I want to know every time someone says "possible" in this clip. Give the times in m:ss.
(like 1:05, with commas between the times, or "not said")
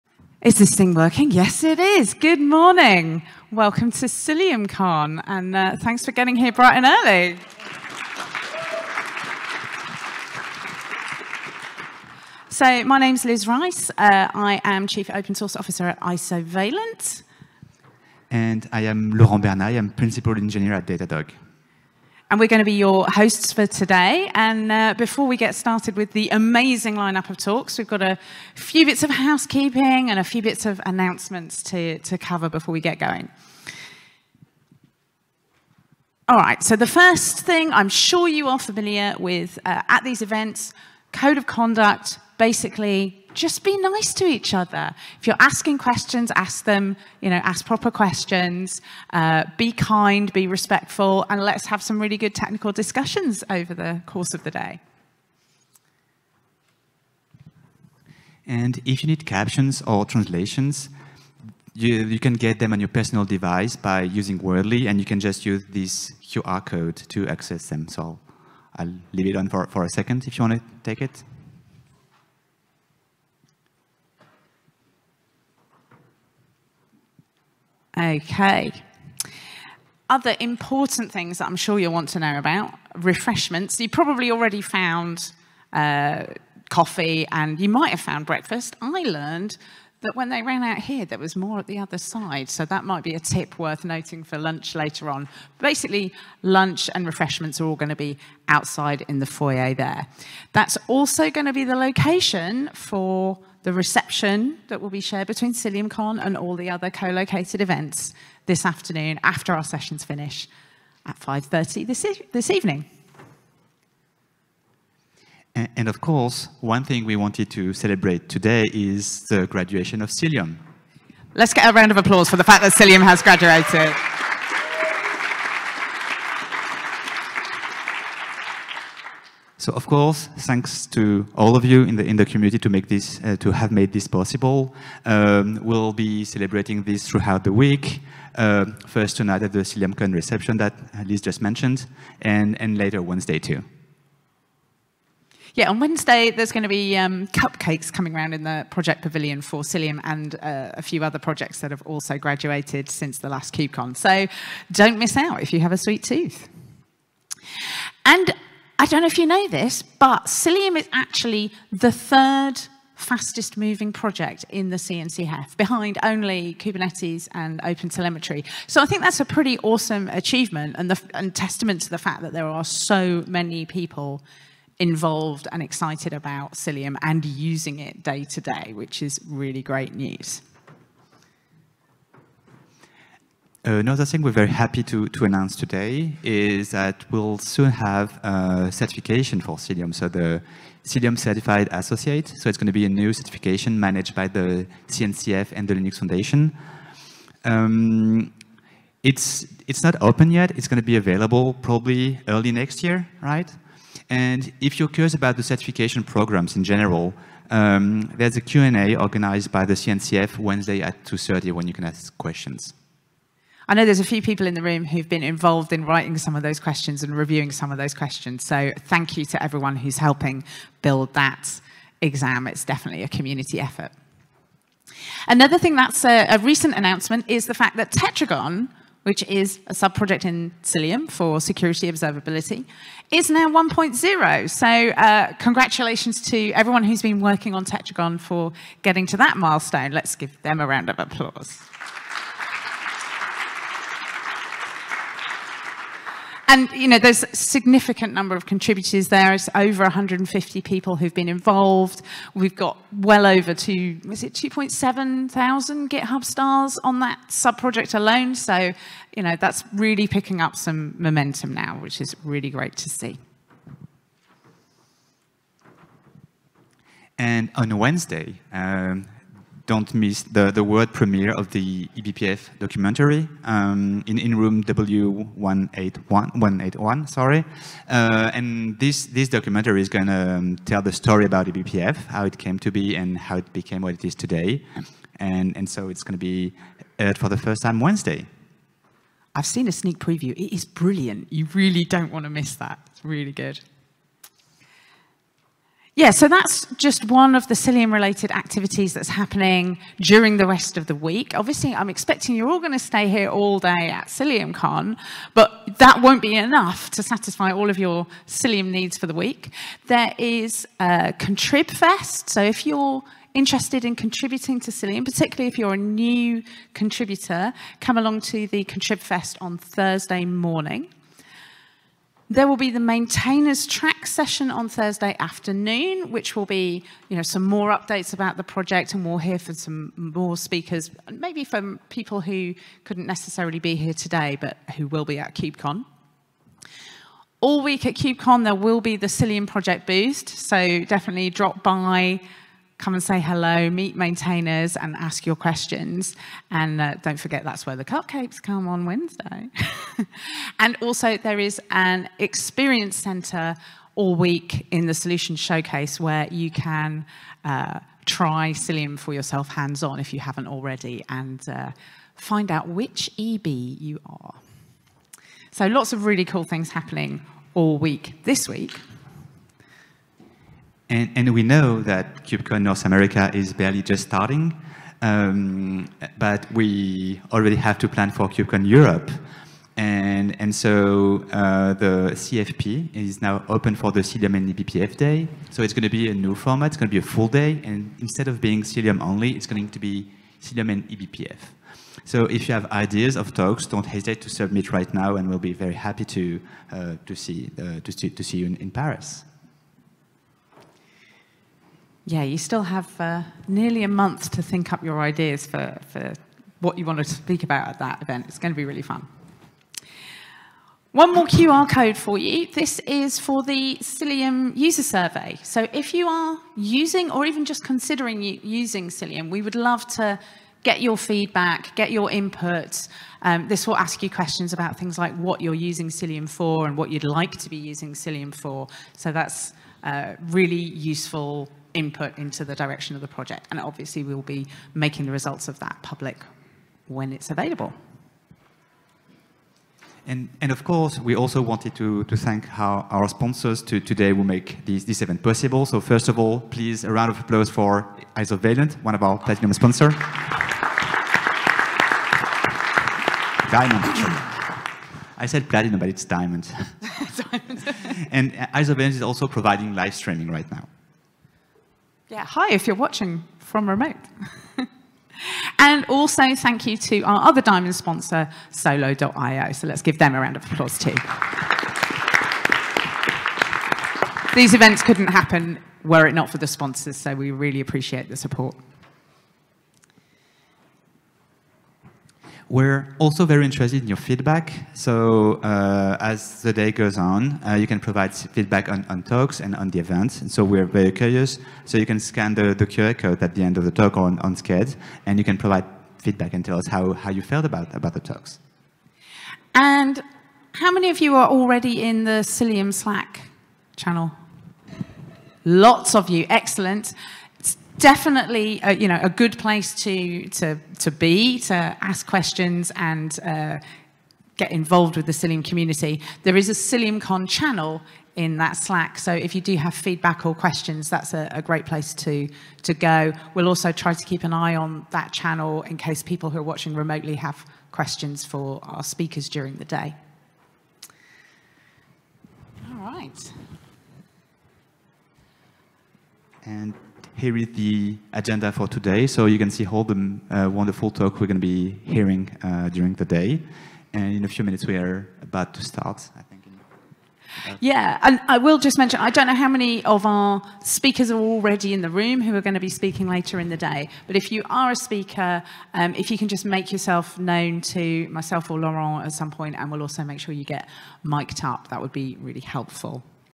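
2:14, 7:25.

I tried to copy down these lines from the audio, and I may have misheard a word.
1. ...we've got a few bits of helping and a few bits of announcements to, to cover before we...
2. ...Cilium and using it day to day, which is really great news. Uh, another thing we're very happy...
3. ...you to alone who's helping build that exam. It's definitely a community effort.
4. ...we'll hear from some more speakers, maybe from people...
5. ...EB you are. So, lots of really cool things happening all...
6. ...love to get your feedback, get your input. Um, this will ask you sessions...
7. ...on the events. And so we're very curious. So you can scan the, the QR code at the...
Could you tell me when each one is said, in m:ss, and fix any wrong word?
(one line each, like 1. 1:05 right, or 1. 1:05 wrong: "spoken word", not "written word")
1. 0:27 wrong: "housekeeping", not "helping"
2. 2:56 right
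3. 3:39 wrong: "everyone", not "alone"
4. 5:29 right
5. 6:03 right
6. 6:59 wrong: "questions", not "sessions"
7. 8:09 right.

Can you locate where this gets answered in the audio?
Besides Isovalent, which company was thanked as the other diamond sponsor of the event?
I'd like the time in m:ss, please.
7:48.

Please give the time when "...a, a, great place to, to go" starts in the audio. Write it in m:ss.
8:41.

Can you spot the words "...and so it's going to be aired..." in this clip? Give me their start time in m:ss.
4:45.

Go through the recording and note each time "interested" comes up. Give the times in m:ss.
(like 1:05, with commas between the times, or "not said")
5:13, 8:03.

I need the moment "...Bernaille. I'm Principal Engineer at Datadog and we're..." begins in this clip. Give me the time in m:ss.
0:19.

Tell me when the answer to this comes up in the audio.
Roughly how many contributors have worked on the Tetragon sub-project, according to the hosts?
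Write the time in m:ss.
4:09.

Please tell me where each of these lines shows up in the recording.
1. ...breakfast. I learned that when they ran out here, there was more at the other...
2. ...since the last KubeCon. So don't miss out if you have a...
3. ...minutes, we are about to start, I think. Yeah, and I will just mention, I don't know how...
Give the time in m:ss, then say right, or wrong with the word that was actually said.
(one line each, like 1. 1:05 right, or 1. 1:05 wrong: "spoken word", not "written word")
1. 1:28 right
2. 2:32 right
3. 9:04 right.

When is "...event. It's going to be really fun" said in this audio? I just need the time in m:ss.
6:48.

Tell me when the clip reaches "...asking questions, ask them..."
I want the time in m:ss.
0:45.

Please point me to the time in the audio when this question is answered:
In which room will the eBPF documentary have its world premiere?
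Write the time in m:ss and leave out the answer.
4:34.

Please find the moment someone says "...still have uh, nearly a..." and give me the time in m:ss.
6:42.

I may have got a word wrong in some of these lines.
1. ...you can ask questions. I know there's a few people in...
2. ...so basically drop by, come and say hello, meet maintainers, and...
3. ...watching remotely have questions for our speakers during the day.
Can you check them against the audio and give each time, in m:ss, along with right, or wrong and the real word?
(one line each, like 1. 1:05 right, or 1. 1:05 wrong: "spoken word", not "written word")
1. 3:31 right
2. 5:40 wrong: "definitely", not "basically"
3. 8:46 right.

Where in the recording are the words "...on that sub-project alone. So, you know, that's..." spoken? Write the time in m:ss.
4:16.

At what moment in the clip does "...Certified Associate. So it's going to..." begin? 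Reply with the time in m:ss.
3:11.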